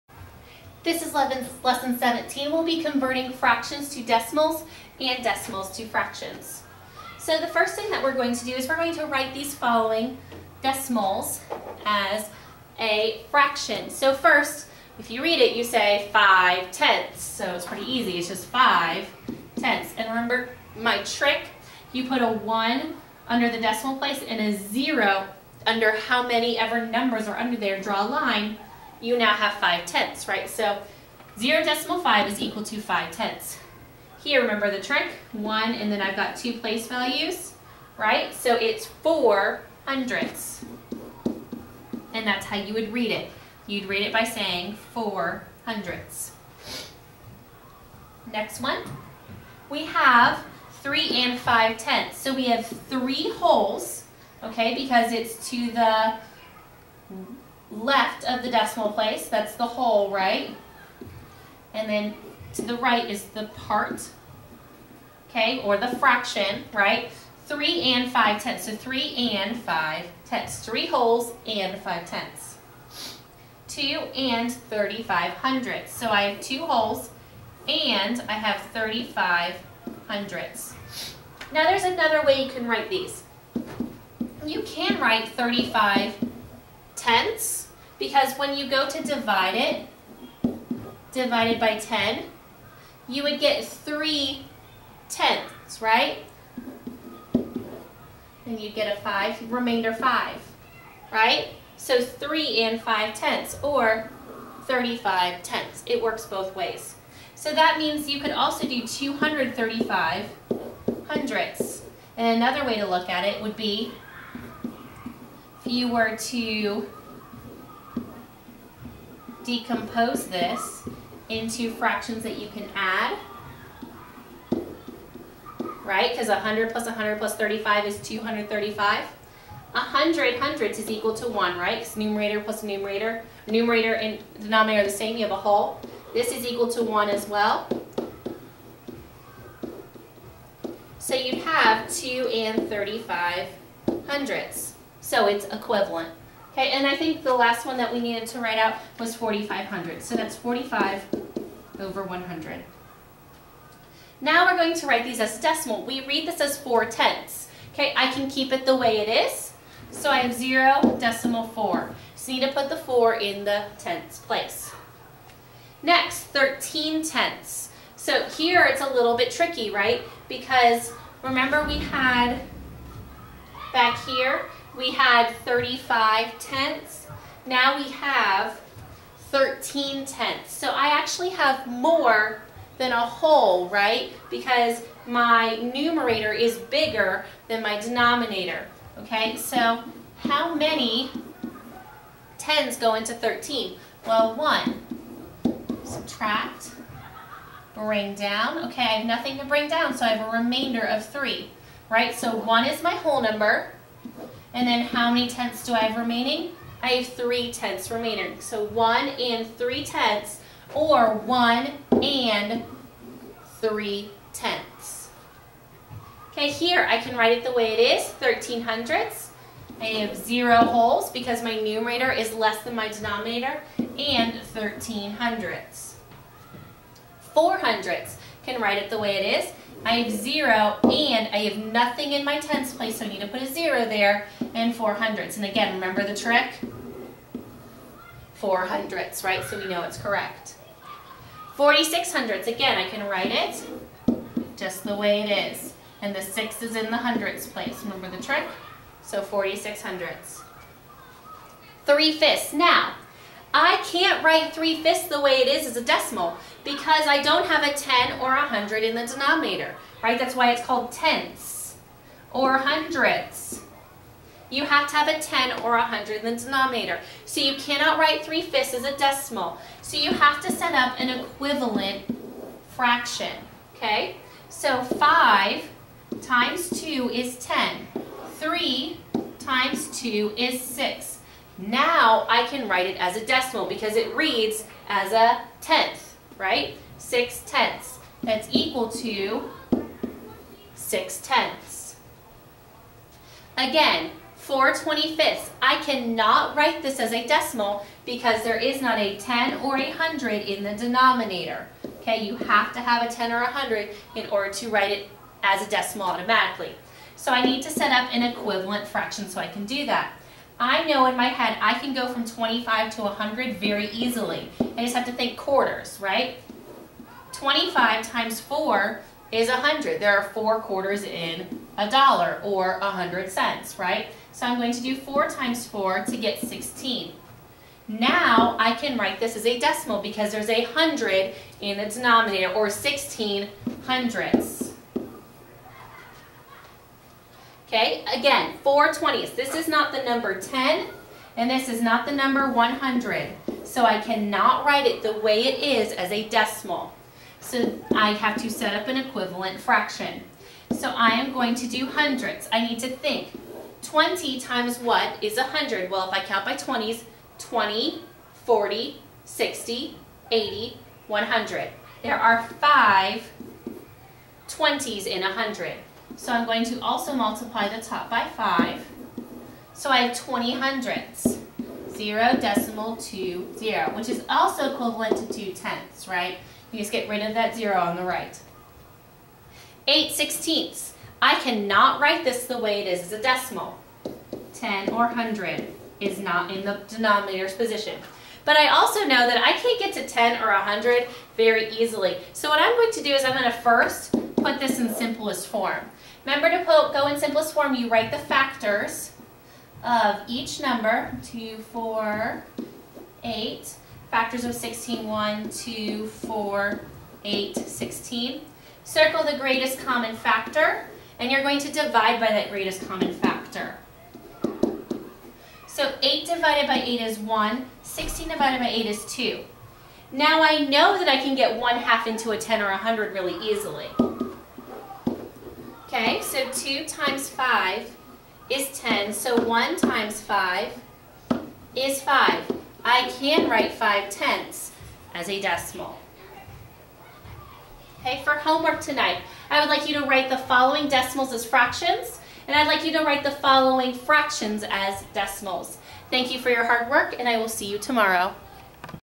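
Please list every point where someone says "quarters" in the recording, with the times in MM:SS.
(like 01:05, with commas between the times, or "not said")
05:15, 05:20.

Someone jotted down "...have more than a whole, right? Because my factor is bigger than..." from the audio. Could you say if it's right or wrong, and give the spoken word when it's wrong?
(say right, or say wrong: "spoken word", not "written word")
wrong: "numerator", not "factor".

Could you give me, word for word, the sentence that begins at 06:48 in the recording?
Circle the greatest common factor, and you're going to divide by that greatest common factor.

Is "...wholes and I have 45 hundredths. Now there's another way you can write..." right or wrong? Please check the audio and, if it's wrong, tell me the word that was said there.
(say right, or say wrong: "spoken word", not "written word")
wrong: "35", not "45".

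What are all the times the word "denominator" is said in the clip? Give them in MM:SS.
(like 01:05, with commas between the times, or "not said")
02:14, 03:07, 03:42, 04:19, 04:26, 05:00, 05:31, 06:26.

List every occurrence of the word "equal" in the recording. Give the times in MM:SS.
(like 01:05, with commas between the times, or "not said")
00:32, 02:10, 02:16, 04:48.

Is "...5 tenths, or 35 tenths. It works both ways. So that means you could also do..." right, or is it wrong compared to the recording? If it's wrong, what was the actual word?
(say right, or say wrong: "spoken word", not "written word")
right.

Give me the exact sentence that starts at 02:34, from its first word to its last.
Now we're going to write these as decimal.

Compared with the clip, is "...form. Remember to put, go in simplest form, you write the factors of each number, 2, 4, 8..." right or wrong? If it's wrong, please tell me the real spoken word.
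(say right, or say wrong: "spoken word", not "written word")
right.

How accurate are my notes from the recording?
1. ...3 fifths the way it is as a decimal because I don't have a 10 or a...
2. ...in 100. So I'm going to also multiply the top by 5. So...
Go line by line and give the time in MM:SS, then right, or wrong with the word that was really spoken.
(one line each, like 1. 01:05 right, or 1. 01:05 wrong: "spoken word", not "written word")
1. 04:14 right
2. 06:05 right.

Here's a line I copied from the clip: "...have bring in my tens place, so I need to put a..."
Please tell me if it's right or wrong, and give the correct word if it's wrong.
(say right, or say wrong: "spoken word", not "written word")
wrong: "nothing", not "bring".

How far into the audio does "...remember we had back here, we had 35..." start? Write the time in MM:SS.
02:51.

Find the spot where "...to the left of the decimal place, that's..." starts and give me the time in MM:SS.
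00:55.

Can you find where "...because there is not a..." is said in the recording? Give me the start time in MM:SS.
04:58.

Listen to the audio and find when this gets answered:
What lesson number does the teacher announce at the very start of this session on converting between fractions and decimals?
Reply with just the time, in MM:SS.
00:01.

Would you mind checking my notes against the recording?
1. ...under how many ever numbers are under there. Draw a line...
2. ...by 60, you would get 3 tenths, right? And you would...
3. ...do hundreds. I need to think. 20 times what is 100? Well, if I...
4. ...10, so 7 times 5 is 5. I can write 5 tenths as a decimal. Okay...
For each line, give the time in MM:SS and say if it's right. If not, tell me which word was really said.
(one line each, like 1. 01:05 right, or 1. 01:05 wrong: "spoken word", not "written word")
1. 00:25 right
2. 01:31 wrong: "10", not "60"
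3. 05:51 right
4. 07:08 wrong: "1", not "7".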